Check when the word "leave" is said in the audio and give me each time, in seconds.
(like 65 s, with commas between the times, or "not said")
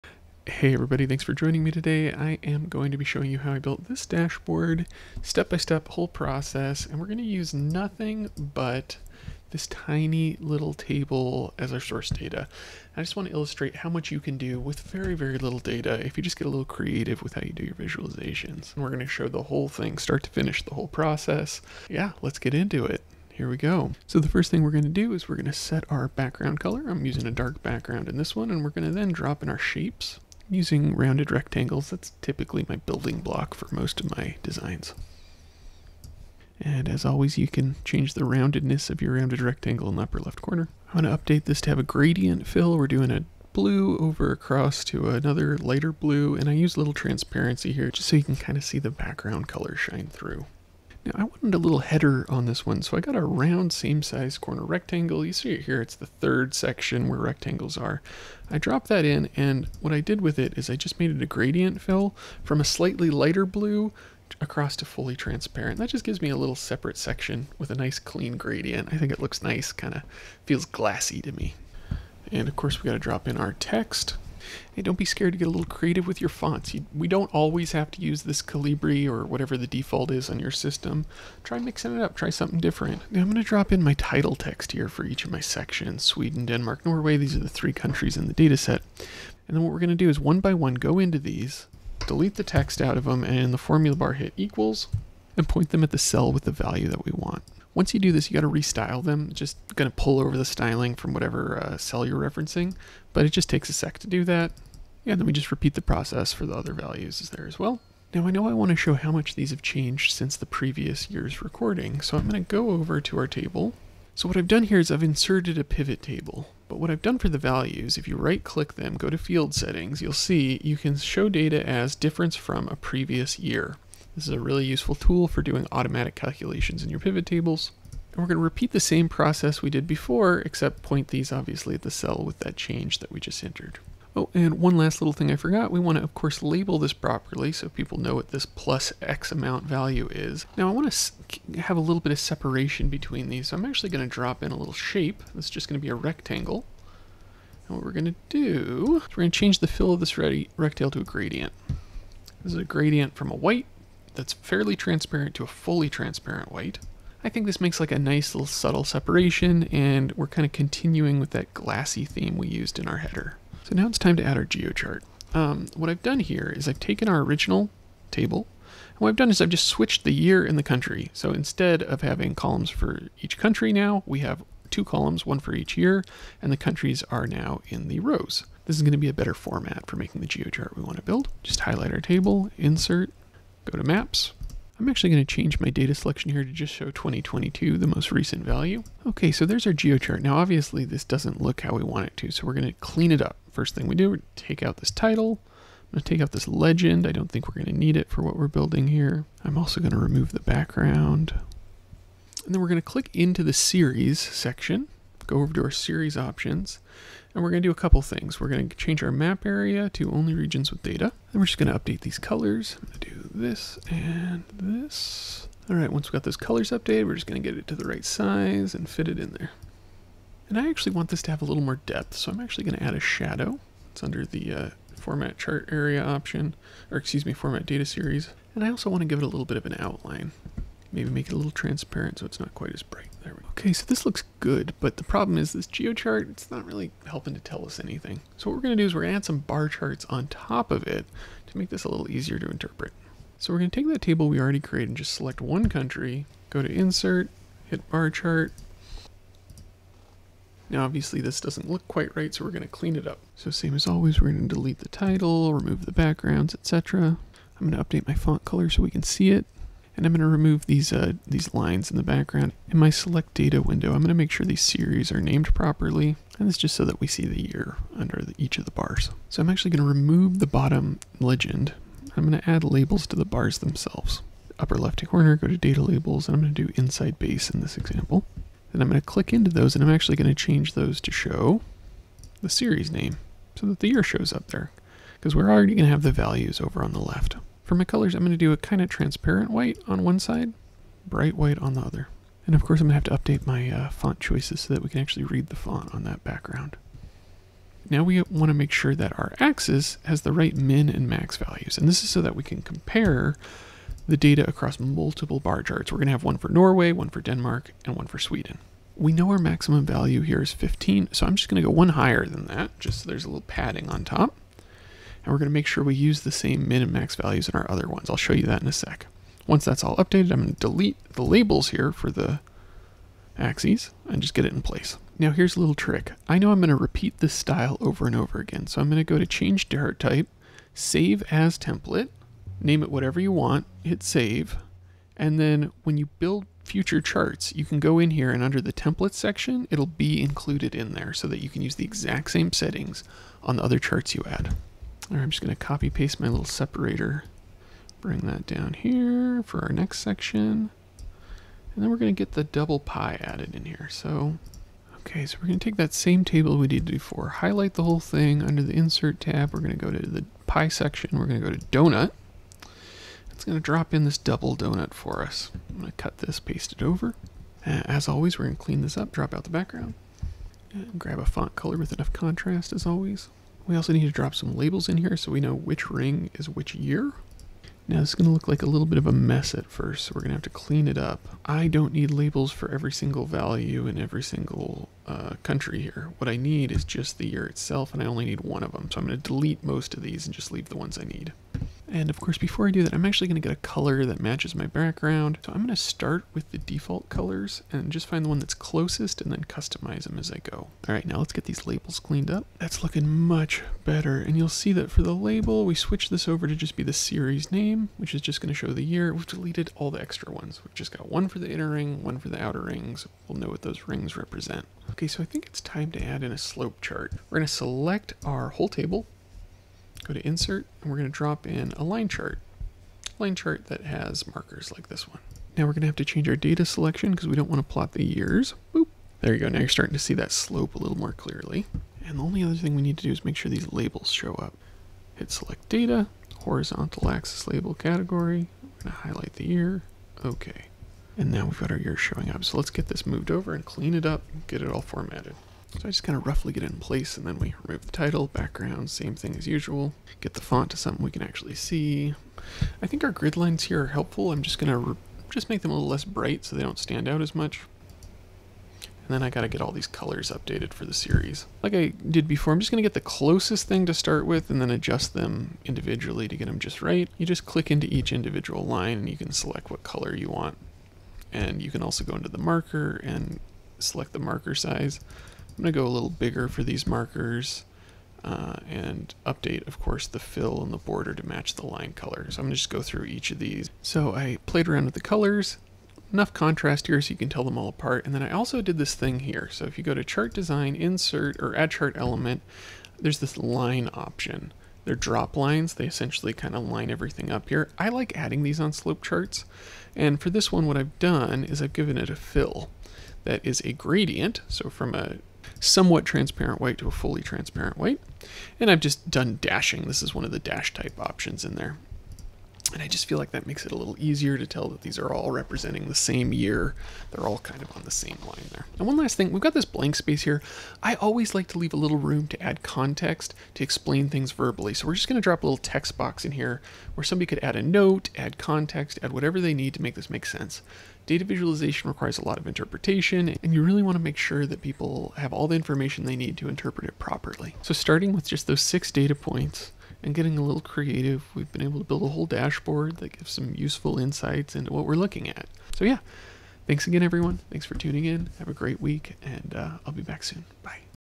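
390 s, 521 s.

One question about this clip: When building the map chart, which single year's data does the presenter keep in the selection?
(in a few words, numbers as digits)
2022.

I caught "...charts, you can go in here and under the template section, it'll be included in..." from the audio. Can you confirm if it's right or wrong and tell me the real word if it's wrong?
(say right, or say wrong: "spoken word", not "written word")
right.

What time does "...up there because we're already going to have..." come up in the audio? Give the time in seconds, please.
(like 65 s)
284 s.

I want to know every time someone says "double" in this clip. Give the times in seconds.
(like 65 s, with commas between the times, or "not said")
352 s, 364 s.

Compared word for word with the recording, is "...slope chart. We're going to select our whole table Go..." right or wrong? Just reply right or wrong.
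right.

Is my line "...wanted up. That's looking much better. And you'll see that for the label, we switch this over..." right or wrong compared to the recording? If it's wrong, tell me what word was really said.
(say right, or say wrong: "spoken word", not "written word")
wrong: "cleaned", not "wanted".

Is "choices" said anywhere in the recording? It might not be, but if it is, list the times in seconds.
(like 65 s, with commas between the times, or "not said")
294 s.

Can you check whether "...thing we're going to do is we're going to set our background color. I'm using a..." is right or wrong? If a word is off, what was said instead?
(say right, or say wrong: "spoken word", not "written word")
right.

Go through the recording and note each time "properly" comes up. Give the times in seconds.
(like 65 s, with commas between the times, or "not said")
136 s, 265 s, 536 s.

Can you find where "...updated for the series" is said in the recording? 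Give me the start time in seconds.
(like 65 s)
460 s.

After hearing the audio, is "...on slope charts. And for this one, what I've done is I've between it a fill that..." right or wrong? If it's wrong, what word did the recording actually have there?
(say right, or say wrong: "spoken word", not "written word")
wrong: "given", not "between".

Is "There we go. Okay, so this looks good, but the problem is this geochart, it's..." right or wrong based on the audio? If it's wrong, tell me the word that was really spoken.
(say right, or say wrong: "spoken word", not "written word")
right.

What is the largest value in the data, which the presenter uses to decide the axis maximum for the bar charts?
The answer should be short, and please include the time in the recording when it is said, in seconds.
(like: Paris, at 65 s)
15, at 310 s.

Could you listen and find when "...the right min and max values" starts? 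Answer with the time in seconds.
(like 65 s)
300 s.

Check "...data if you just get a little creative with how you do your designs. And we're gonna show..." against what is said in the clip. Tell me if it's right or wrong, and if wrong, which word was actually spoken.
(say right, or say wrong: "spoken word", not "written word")
wrong: "visualizations", not "designs".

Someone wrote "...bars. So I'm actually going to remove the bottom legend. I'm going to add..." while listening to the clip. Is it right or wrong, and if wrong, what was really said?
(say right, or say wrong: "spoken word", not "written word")
right.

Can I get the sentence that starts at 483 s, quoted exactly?
So I played around with the colors, enough contrast here so you can tell them all apart.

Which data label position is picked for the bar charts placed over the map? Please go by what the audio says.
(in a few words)
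Inside base.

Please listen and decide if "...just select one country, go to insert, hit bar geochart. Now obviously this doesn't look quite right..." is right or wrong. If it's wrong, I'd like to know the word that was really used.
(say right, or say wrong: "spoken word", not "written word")
wrong: "chart", not "geochart".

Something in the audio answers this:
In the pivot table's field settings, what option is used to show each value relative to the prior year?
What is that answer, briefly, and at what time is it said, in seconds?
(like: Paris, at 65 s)
Difference from a previous year, at 121 s.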